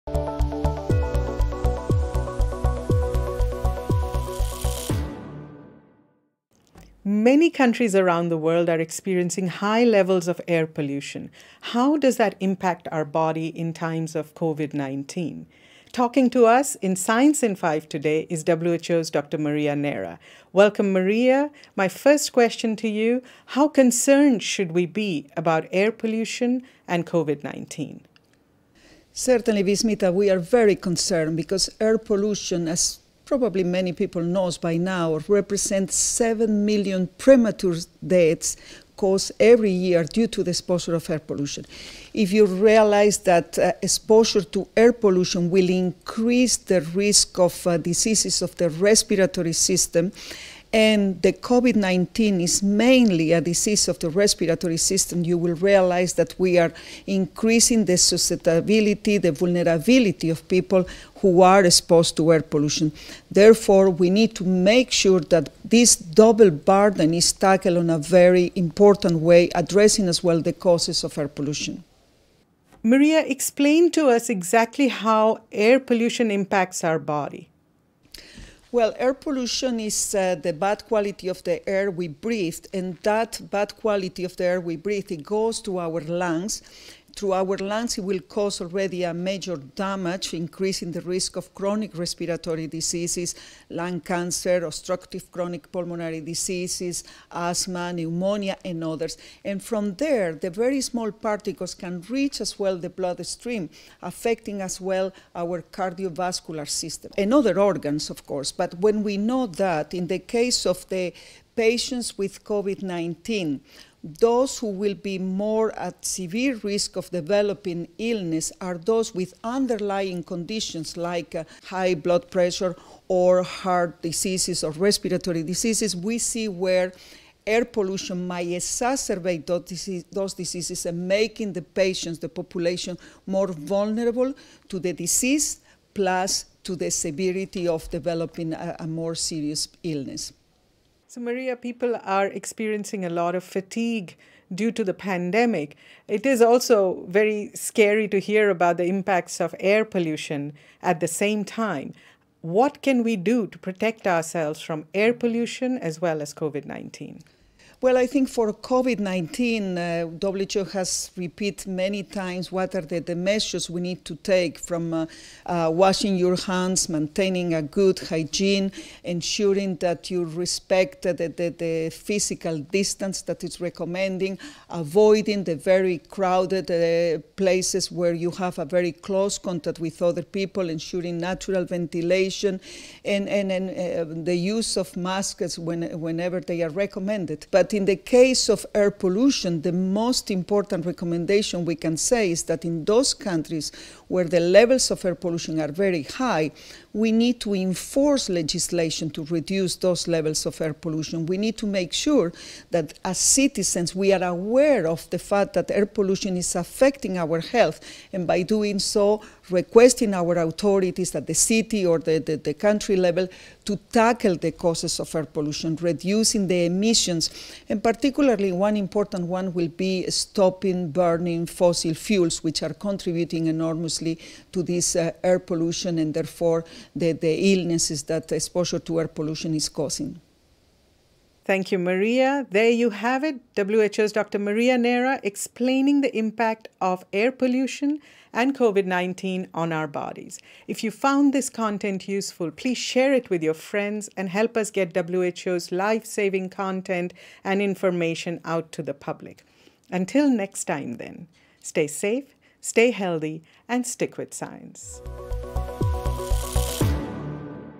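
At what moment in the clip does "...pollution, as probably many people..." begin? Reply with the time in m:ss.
0:31.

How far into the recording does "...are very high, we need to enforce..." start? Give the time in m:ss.
3:15.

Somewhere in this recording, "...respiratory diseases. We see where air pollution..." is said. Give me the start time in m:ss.
2:04.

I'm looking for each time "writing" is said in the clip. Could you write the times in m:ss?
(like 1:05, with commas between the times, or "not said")
not said.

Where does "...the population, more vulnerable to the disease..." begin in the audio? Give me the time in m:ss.
2:12.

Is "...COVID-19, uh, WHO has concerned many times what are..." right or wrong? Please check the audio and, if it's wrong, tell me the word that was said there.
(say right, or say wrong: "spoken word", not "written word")
wrong: "repeated", not "concerned".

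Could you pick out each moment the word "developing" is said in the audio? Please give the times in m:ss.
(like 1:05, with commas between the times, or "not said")
1:57, 2:17.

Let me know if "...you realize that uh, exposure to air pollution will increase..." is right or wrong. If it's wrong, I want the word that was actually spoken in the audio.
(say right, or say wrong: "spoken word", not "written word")
right.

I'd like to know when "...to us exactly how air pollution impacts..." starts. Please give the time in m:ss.
1:13.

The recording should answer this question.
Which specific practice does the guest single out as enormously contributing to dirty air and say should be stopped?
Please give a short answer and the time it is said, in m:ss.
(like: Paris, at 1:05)
Burning fossil fuels, at 3:40.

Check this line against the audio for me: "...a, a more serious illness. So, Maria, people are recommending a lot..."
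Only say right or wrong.
wrong.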